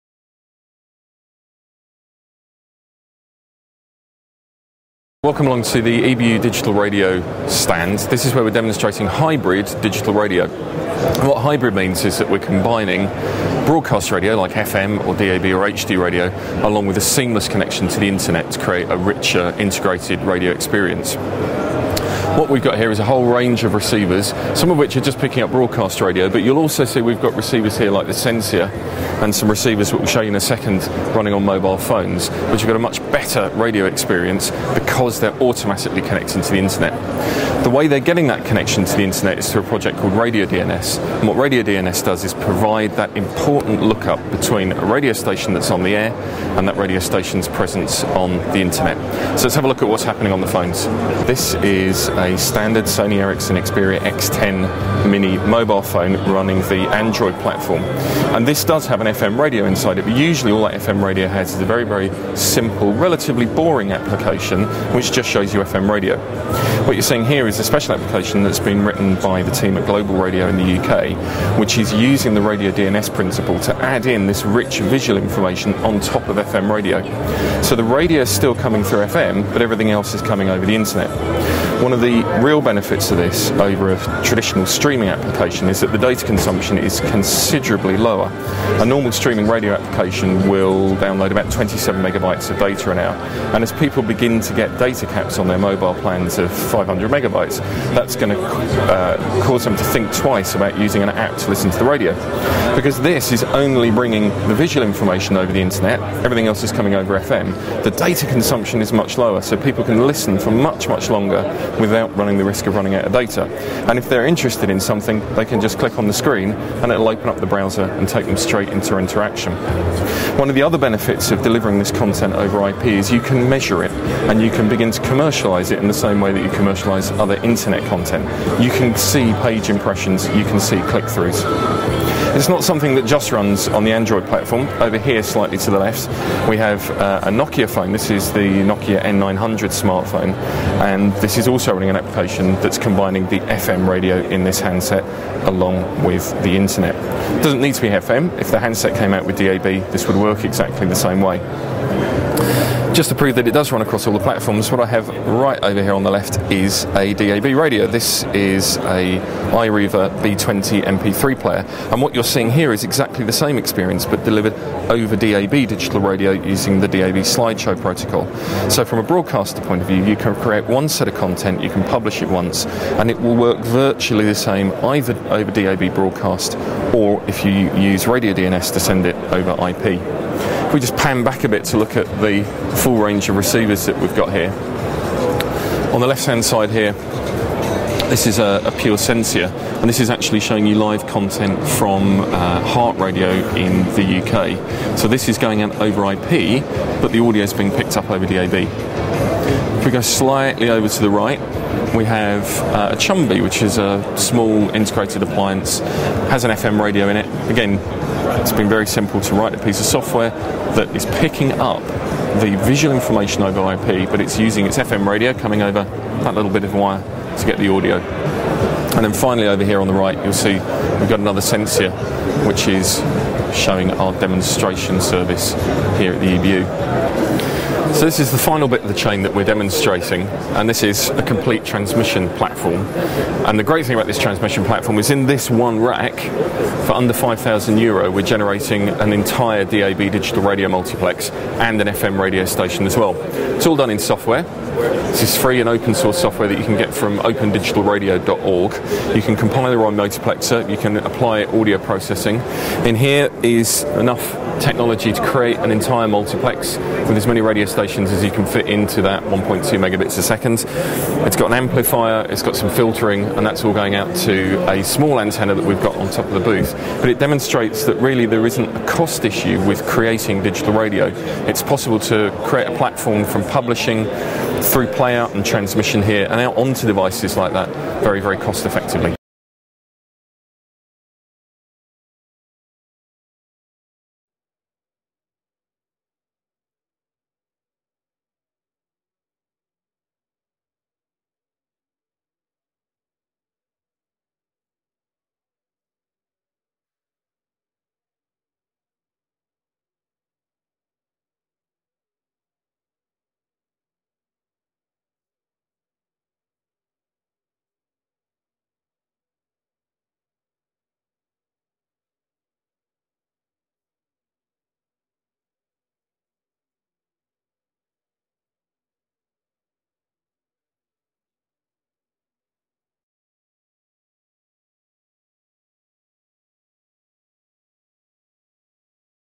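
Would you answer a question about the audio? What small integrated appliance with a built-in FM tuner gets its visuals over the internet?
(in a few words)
Chumby.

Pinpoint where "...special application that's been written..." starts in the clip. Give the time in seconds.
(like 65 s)
67 s.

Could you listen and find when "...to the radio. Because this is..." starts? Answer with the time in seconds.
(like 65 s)
101 s.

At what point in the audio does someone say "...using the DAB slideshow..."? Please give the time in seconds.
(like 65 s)
166 s.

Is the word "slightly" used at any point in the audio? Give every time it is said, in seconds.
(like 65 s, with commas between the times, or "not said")
135 s, 199 s.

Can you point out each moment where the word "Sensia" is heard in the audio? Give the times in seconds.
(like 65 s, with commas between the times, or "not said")
28 s, 188 s, 221 s.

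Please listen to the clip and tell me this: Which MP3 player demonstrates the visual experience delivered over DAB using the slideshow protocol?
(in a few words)
iRiver B20.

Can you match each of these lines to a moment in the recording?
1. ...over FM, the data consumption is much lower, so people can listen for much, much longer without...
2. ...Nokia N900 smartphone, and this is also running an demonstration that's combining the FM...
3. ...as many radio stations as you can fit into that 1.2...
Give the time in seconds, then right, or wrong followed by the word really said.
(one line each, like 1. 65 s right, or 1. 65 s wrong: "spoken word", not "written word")
1. 106 s right
2. 138 s wrong: "application", not "demonstration"
3. 257 s right.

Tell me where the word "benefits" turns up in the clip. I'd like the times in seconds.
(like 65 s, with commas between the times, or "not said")
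82 s, 120 s.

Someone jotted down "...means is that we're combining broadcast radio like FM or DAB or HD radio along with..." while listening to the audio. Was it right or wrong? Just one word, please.
right.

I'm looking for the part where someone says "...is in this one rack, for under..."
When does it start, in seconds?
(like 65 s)
234 s.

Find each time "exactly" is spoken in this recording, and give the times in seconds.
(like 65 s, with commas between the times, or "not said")
150 s, 162 s.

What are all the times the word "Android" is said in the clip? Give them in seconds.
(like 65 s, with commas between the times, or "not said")
56 s, 133 s.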